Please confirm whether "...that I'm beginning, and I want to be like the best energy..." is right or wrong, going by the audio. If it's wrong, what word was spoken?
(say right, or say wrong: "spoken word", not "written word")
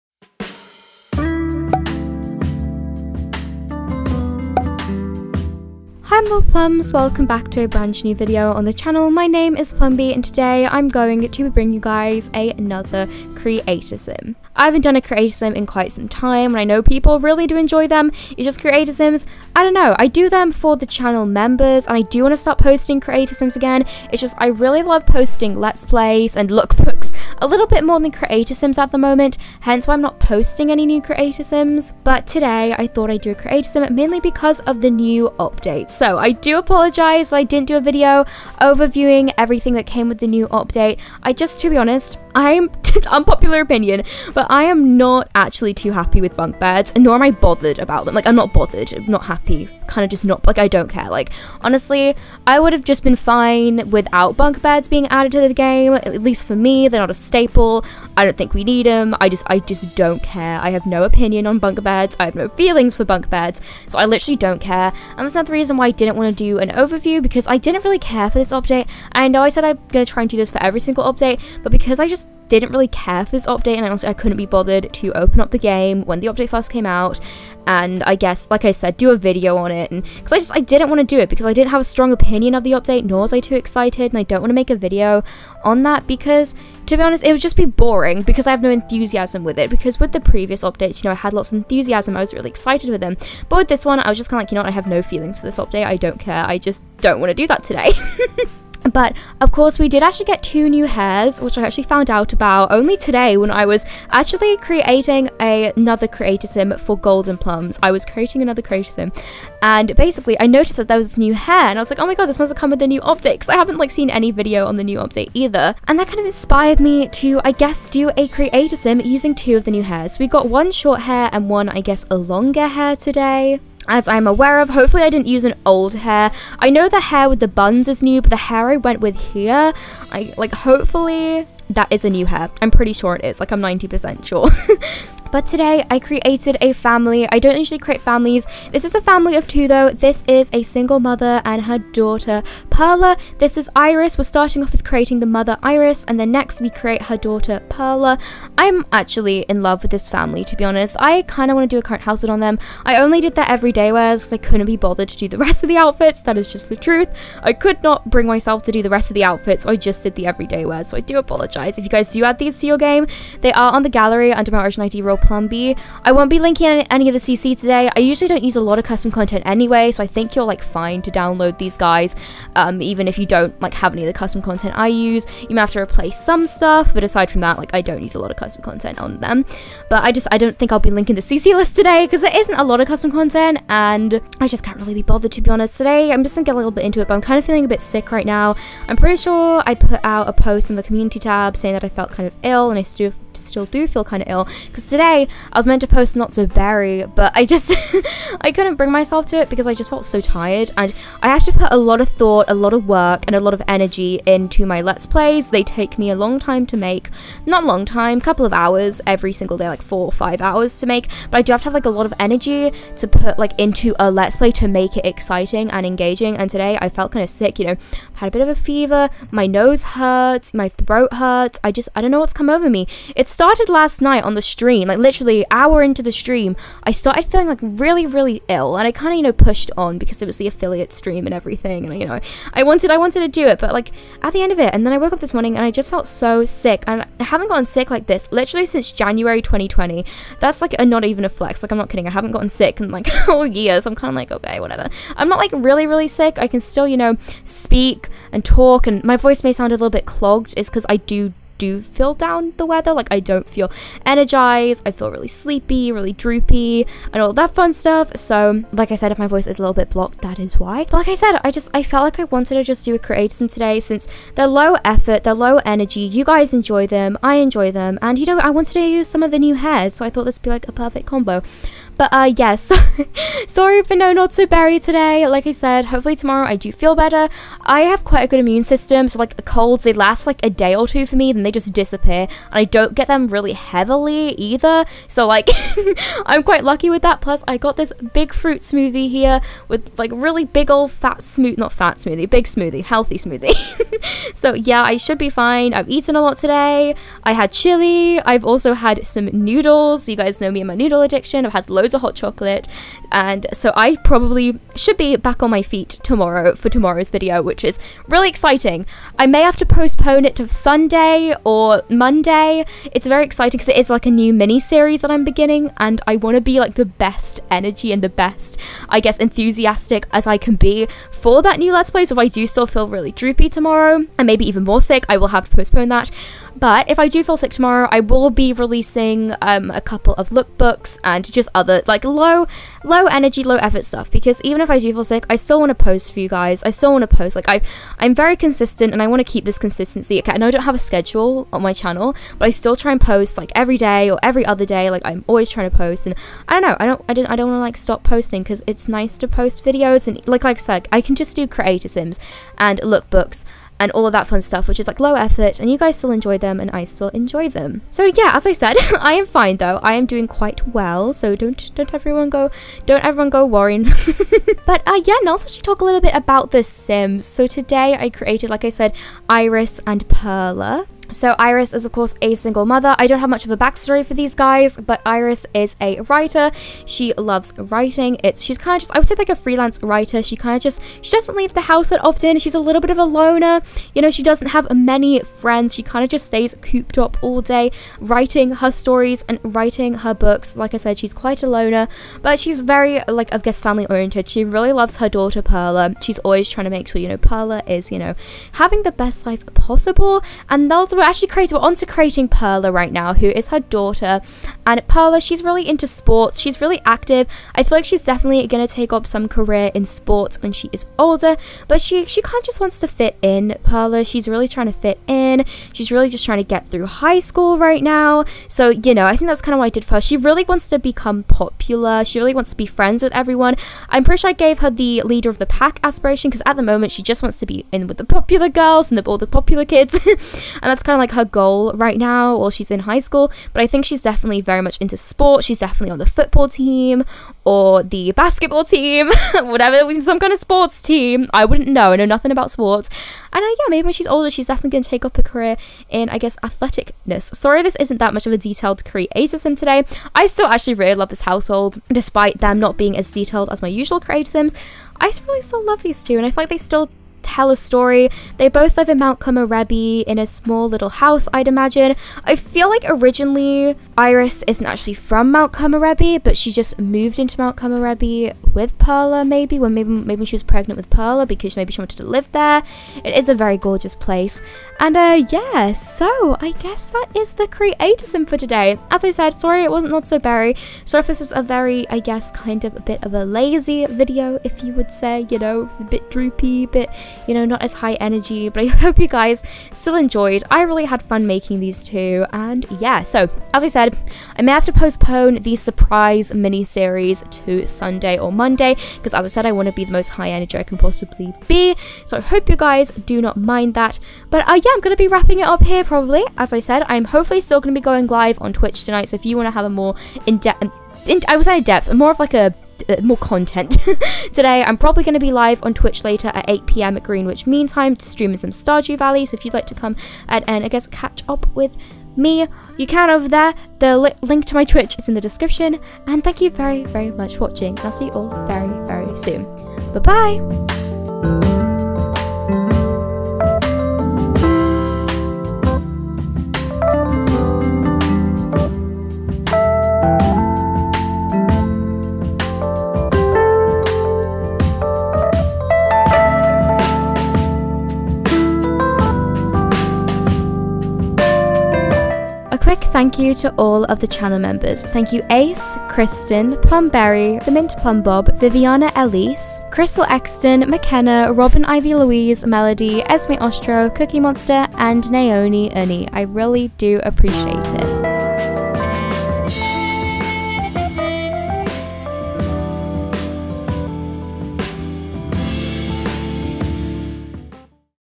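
right.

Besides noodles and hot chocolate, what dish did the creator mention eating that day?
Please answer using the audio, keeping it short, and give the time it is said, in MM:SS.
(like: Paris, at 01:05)
Chili, at 04:57.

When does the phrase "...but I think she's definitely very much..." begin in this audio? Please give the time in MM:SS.
07:13.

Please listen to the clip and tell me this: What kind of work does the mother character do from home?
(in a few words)
Freelance writer.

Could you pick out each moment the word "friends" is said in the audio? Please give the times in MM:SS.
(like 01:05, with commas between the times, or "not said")
06:25, 07:02.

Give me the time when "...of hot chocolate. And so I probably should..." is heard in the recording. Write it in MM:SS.
05:01.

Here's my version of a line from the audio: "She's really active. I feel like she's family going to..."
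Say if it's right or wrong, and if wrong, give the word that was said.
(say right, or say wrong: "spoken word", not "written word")
wrong: "definitely", not "family".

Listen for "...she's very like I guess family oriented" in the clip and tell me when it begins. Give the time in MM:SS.
06:32.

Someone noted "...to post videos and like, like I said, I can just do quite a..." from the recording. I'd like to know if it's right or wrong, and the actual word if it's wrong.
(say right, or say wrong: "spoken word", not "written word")
wrong: "create", not "quite".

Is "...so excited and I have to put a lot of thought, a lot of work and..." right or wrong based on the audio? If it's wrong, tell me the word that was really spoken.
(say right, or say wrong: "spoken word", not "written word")
wrong: "tired", not "excited".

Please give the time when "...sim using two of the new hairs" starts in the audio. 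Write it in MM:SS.
01:58.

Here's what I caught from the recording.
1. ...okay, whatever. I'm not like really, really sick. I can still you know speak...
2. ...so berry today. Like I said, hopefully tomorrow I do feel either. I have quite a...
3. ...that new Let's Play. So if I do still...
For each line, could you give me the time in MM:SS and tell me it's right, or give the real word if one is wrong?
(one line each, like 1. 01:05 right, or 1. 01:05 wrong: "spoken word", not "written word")
1. 04:04 right
2. 04:34 wrong: "better", not "either"
3. 05:21 right.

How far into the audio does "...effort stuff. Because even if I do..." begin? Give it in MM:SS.
05:33.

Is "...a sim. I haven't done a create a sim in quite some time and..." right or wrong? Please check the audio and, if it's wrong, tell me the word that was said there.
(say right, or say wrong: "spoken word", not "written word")
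right.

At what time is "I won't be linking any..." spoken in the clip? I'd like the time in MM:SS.
02:46.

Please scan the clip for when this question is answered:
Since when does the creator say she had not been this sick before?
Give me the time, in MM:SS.
03:58.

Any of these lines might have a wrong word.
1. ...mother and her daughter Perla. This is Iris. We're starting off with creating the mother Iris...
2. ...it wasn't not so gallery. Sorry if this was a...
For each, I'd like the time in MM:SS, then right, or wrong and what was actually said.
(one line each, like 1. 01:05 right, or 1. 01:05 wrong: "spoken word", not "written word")
1. 02:20 right
2. 07:59 wrong: "berry", not "gallery".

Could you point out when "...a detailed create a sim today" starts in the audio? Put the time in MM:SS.
07:28.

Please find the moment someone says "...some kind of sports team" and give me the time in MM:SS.
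07:20.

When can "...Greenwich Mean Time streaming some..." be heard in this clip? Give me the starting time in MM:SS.
08:37.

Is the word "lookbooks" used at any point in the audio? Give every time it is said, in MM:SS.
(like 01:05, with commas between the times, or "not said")
00:26, 05:30, 05:52.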